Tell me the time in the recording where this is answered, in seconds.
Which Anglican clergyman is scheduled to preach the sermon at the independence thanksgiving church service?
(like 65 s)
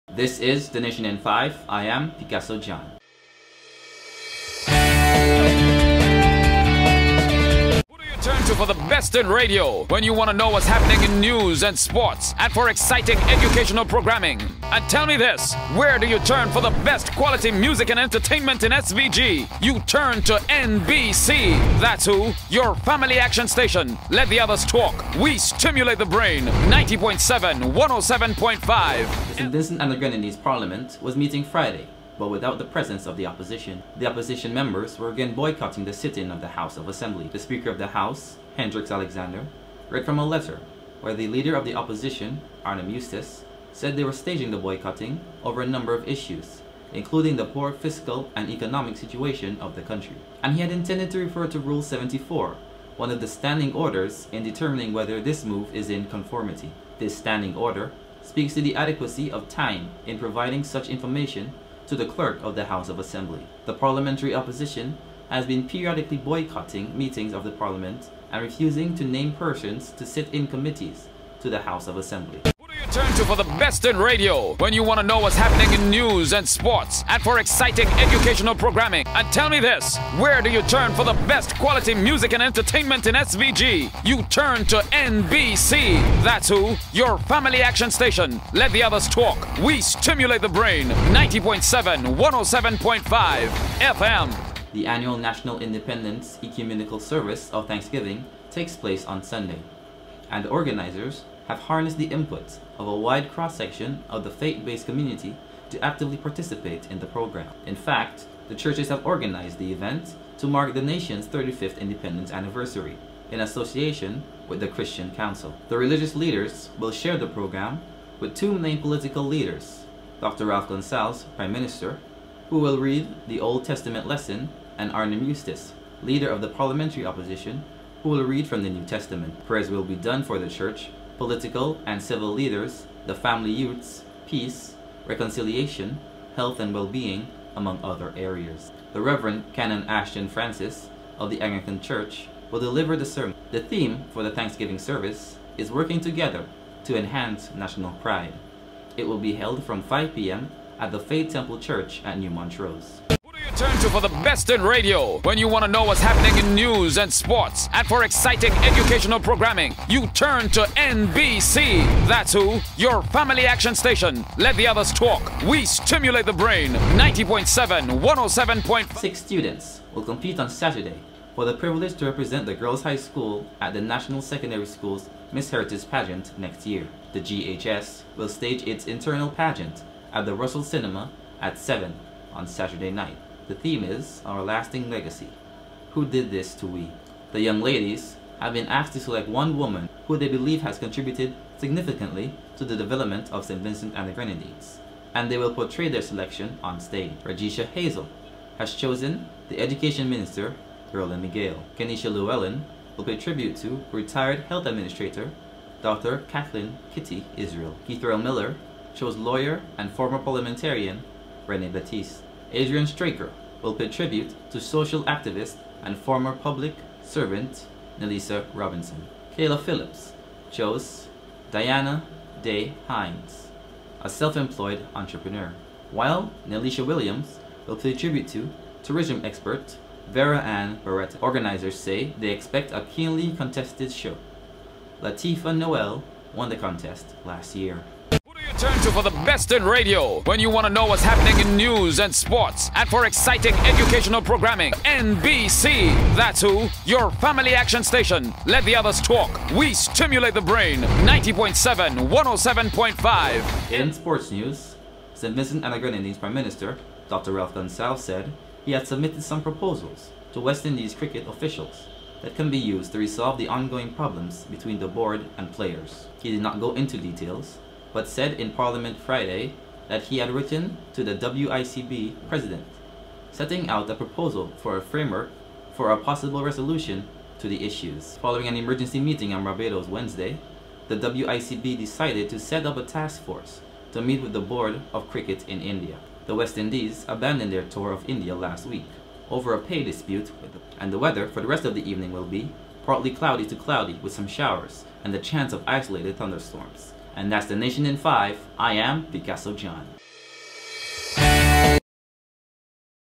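139 s.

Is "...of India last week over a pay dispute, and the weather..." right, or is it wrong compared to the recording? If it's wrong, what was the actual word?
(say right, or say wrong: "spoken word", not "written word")
right.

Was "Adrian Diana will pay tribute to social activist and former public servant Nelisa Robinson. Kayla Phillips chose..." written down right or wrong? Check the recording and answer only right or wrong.
wrong.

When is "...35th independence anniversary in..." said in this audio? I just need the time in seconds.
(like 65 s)
111 s.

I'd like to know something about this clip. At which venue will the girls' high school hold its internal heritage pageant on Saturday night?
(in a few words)
Russell Cinema.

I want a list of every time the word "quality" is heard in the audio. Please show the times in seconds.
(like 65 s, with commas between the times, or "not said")
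17 s, 81 s.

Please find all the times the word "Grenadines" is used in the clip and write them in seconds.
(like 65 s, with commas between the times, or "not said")
29 s, 194 s, 255 s.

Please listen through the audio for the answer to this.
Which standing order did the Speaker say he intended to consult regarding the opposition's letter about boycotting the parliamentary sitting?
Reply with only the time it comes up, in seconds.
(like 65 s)
51 s.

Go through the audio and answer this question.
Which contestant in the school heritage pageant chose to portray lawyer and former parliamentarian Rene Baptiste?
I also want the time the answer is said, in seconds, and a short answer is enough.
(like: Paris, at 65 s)
Keithrell Miller, at 207 s.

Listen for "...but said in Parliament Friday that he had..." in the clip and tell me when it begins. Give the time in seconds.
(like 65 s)
267 s.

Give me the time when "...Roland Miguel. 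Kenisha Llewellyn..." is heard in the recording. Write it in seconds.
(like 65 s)
200 s.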